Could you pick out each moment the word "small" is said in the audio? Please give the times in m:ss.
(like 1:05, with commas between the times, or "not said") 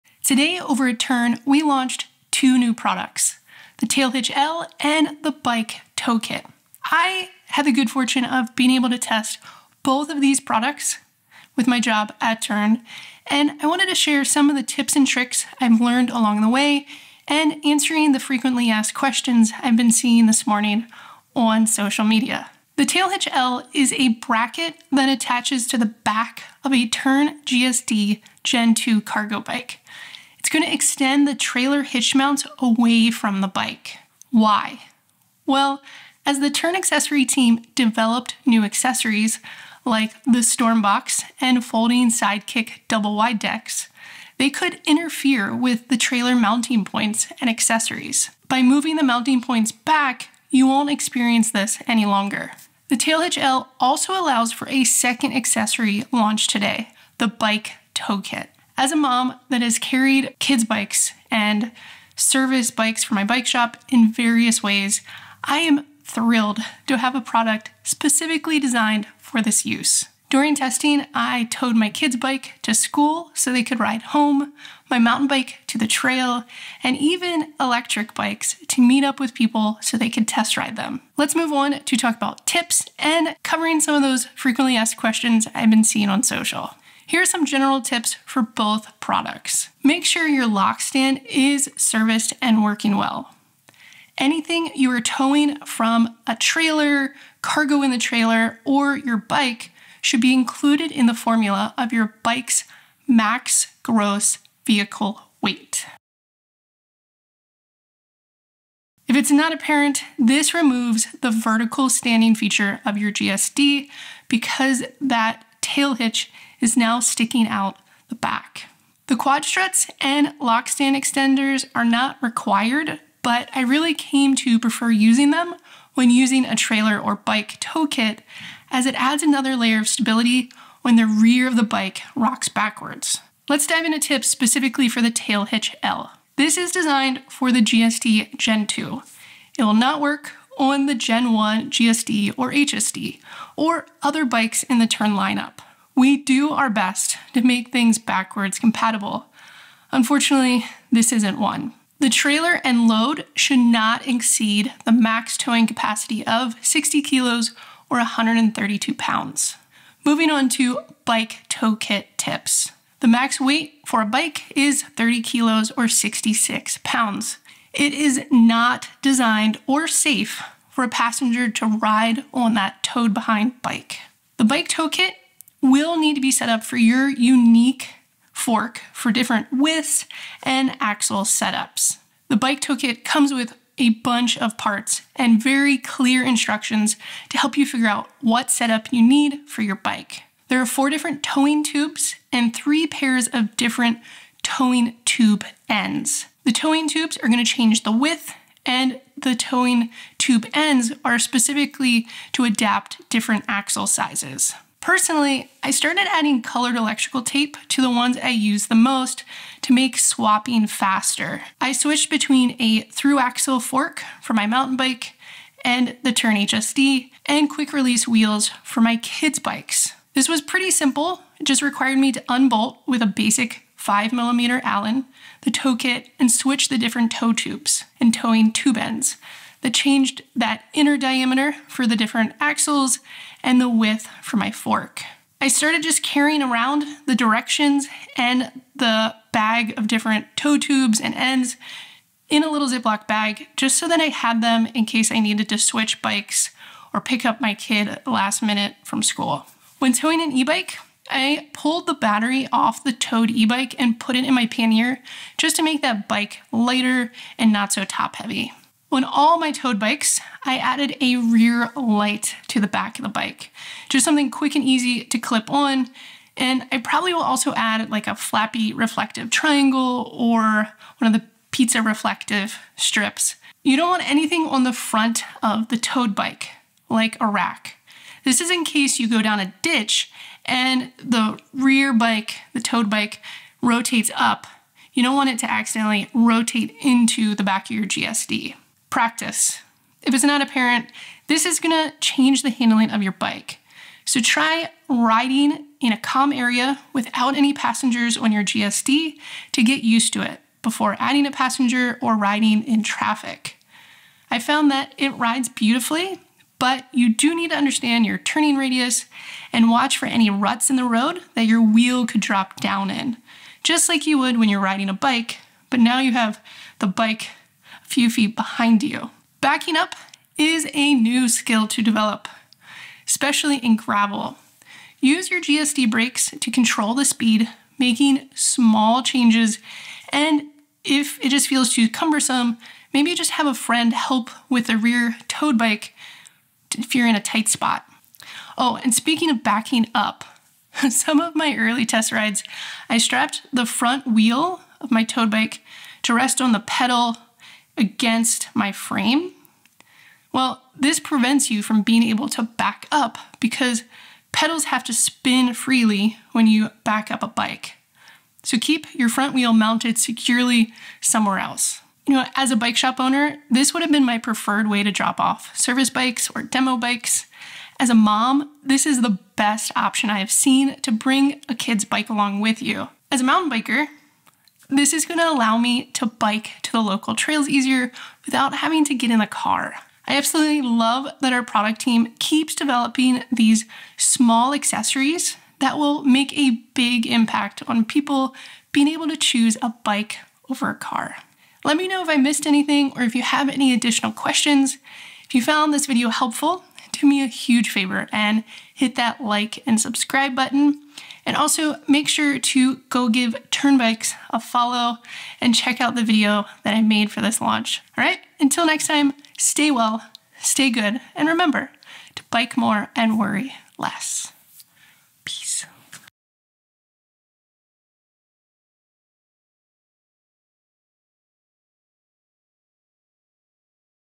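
5:28, 6:23.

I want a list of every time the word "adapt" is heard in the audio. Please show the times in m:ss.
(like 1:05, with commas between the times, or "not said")
3:22.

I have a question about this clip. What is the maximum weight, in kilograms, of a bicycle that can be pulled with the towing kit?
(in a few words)
30.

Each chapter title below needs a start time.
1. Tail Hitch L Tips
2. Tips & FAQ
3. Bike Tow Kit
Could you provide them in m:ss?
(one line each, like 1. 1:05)
1. 2:14
2. 1:22
3. 2:41.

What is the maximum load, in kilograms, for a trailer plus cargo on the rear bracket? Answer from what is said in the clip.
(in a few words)
60.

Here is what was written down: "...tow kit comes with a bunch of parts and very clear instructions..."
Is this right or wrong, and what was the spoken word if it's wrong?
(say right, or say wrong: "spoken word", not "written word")
right.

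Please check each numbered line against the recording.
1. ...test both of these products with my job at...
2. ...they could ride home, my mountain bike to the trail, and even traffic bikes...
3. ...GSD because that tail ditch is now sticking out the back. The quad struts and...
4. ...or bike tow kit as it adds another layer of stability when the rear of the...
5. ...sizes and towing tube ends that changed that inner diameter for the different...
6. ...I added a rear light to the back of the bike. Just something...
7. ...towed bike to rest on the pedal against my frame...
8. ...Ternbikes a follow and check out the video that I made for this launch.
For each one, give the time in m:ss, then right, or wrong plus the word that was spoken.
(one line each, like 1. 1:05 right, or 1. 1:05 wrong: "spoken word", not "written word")
1. 0:08 right
2. 1:13 wrong: "electric", not "traffic"
3. 1:53 wrong: "hitch", not "ditch"
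4. 2:06 right
5. 3:47 wrong: "tubes", not "sizes"
6. 4:20 right
7. 5:45 right
8. 6:43 right.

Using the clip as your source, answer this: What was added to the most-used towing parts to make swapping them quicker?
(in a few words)
colored electrical tape.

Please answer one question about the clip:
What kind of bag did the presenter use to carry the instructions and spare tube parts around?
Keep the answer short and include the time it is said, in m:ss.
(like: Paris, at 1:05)
Ziploc bag, at 4:02.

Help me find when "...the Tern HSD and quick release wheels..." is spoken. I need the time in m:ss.
3:36.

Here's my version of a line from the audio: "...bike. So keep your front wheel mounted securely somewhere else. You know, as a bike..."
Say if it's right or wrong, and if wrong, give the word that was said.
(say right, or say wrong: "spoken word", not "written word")
right.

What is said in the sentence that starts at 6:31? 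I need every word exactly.
Let me know if I missed anything or if you have any additional questions.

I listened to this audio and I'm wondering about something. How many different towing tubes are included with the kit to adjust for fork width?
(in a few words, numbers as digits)
4.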